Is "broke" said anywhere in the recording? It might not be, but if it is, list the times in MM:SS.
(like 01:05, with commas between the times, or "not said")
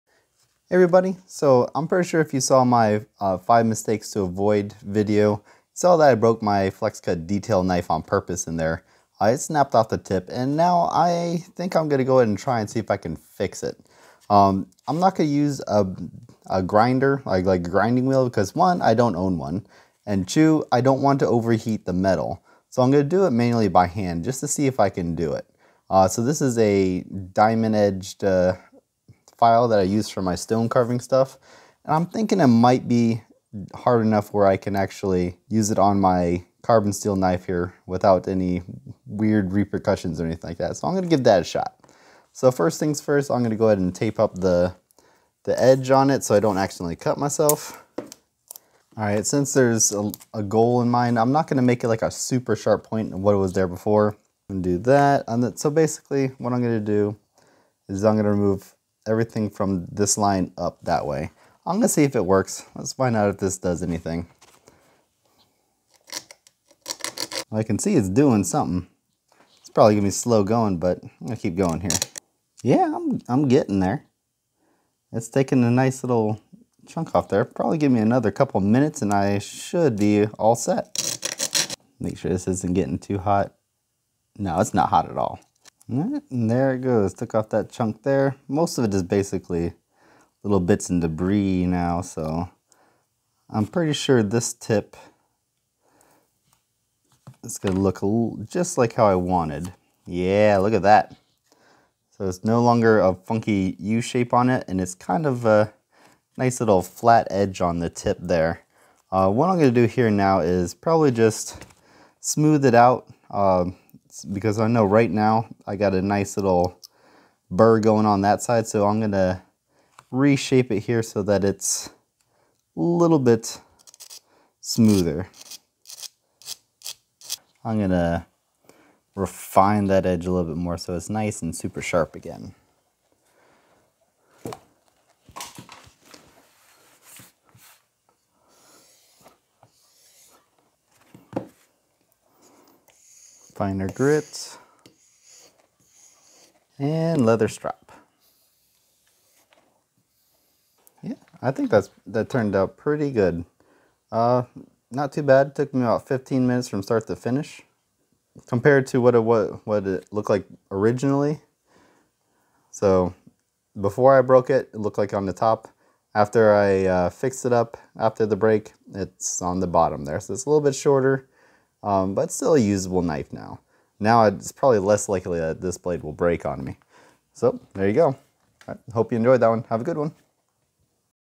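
00:06, 02:44.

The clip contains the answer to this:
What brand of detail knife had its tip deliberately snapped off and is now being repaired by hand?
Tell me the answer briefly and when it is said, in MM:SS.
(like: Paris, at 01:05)
Flexcut, at 00:06.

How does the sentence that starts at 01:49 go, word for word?
Uh, what I'm gonna do here now is probably just smooth it out.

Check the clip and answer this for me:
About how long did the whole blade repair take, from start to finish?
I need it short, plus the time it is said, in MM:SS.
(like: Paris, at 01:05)
15 minutes, at 02:36.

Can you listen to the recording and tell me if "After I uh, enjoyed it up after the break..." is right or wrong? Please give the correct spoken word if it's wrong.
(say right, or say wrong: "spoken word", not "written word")
wrong: "fixed", not "enjoyed".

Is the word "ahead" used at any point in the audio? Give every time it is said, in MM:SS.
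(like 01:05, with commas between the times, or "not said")
00:12, 00:43.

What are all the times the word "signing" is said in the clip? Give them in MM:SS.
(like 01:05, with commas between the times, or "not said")
not said.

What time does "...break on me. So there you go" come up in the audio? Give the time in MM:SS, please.
02:56.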